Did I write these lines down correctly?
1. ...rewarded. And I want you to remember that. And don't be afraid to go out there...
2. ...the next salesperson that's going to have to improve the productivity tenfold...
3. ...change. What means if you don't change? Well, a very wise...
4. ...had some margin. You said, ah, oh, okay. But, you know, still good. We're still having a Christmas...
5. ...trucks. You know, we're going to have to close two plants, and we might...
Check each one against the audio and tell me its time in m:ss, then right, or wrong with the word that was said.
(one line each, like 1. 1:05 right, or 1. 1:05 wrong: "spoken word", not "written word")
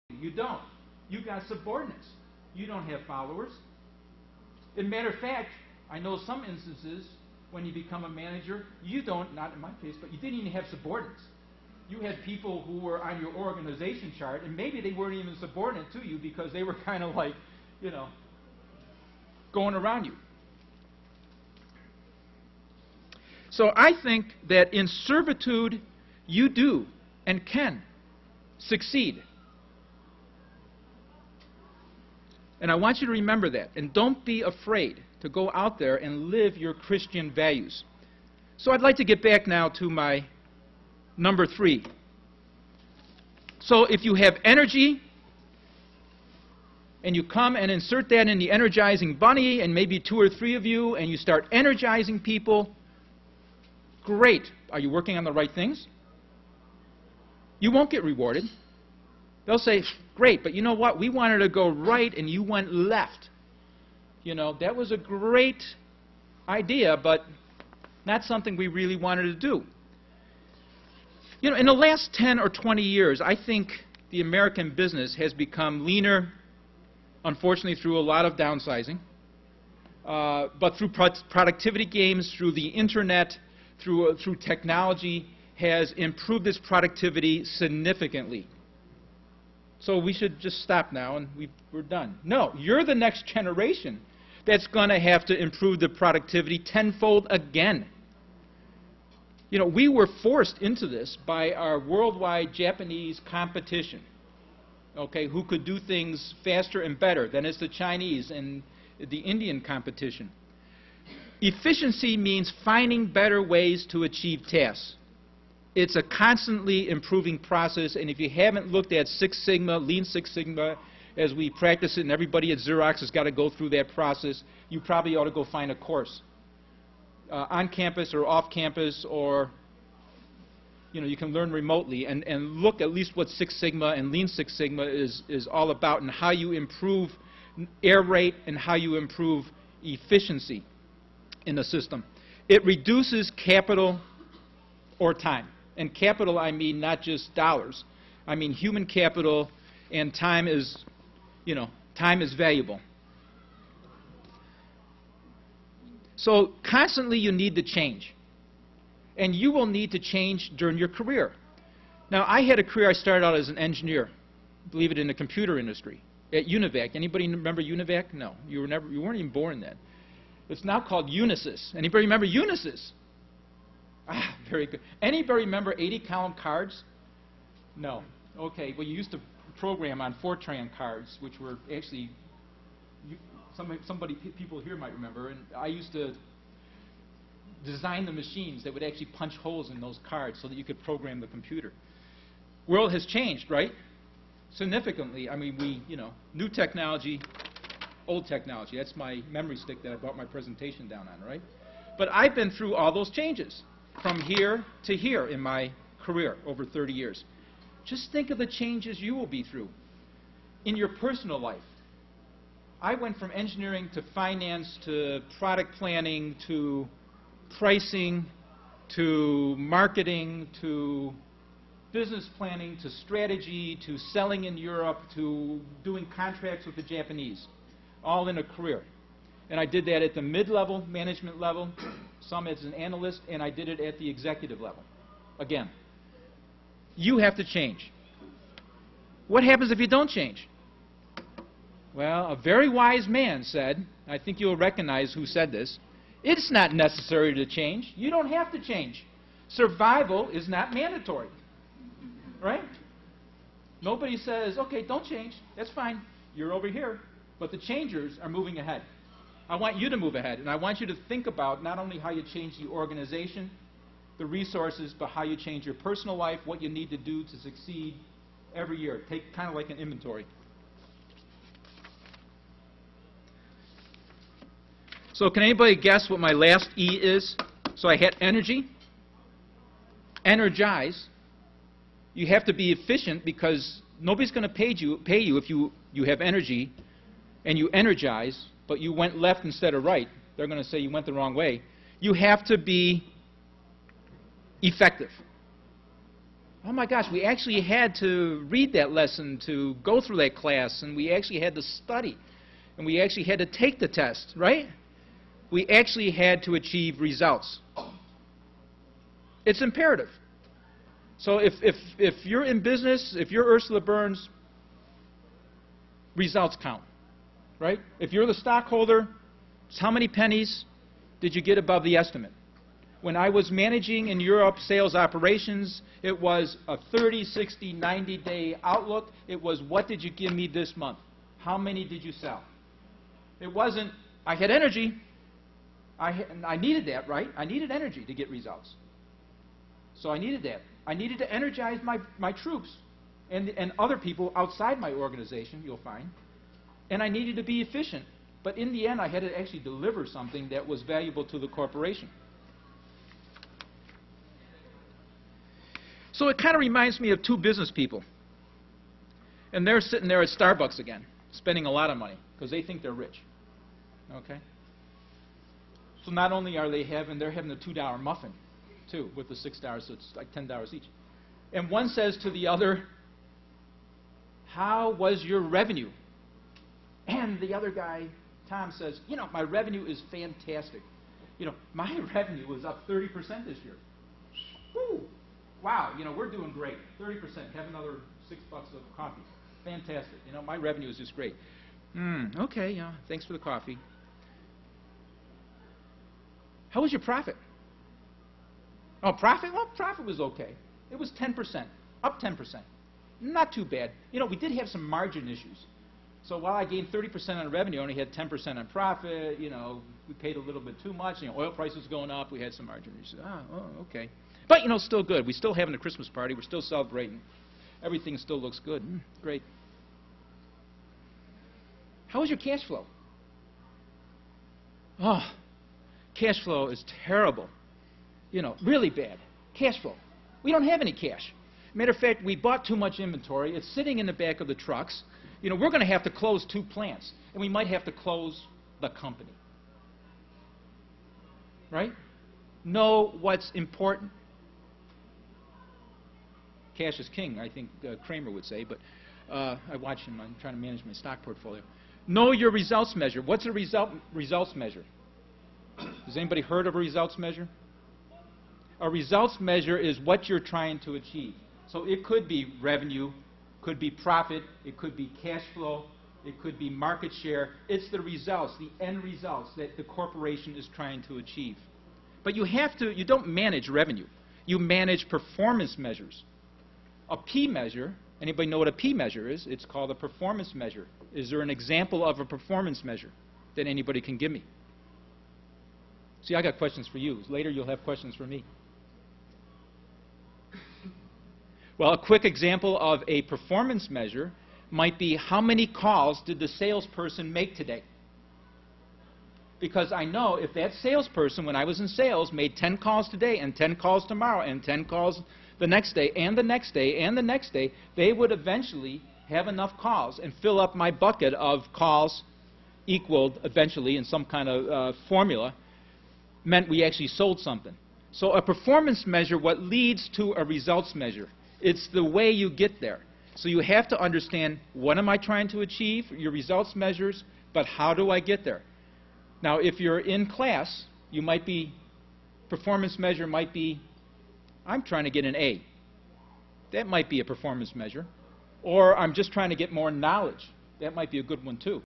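1. 0:28 wrong: "succeed", not "rewarded"
2. 1:32 wrong: "generation", not "salesperson"
3. 3:57 wrong: "happens", not "means"
4. 6:52 right
5. 7:14 right.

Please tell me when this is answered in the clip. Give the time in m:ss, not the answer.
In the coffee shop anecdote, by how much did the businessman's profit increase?
6:42.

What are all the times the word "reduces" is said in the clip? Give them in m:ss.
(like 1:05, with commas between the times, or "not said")
2:22.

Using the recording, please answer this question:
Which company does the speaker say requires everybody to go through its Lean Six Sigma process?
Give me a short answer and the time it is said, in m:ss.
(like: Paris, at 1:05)
Xerox, at 2:02.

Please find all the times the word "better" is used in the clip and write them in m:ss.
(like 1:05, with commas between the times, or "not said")
1:46, 1:53.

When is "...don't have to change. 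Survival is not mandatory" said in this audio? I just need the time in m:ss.
4:08.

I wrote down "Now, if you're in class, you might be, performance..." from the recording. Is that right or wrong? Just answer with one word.
right.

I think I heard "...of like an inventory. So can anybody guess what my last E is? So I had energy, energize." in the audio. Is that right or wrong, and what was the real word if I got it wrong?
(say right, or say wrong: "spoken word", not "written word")
right.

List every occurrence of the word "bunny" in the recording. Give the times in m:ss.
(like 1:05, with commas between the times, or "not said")
0:49.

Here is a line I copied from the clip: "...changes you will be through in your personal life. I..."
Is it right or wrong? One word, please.
right.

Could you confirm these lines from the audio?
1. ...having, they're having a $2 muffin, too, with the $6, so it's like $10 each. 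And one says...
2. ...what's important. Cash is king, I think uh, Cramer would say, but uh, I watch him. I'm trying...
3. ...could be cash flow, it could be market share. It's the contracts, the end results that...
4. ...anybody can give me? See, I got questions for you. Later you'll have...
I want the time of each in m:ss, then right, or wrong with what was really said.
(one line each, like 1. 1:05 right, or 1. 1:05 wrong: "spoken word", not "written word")
1. 6:06 right
2. 7:23 right
3. 7:44 wrong: "results", not "contracts"
4. 8:03 right.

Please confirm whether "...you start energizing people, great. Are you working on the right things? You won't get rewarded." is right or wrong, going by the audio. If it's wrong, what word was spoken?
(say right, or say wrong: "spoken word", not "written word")
right.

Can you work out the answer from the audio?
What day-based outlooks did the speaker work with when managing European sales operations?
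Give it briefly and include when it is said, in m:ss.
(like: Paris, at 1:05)
30, 60, 90 day, at 5:26.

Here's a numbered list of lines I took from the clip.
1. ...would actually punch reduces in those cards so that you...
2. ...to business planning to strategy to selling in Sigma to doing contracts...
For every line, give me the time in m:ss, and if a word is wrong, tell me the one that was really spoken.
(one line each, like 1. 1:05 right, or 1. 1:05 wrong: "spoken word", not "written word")
1. 3:08 wrong: "holes", not "reduces"
2. 3:40 wrong: "Europe", not "Sigma".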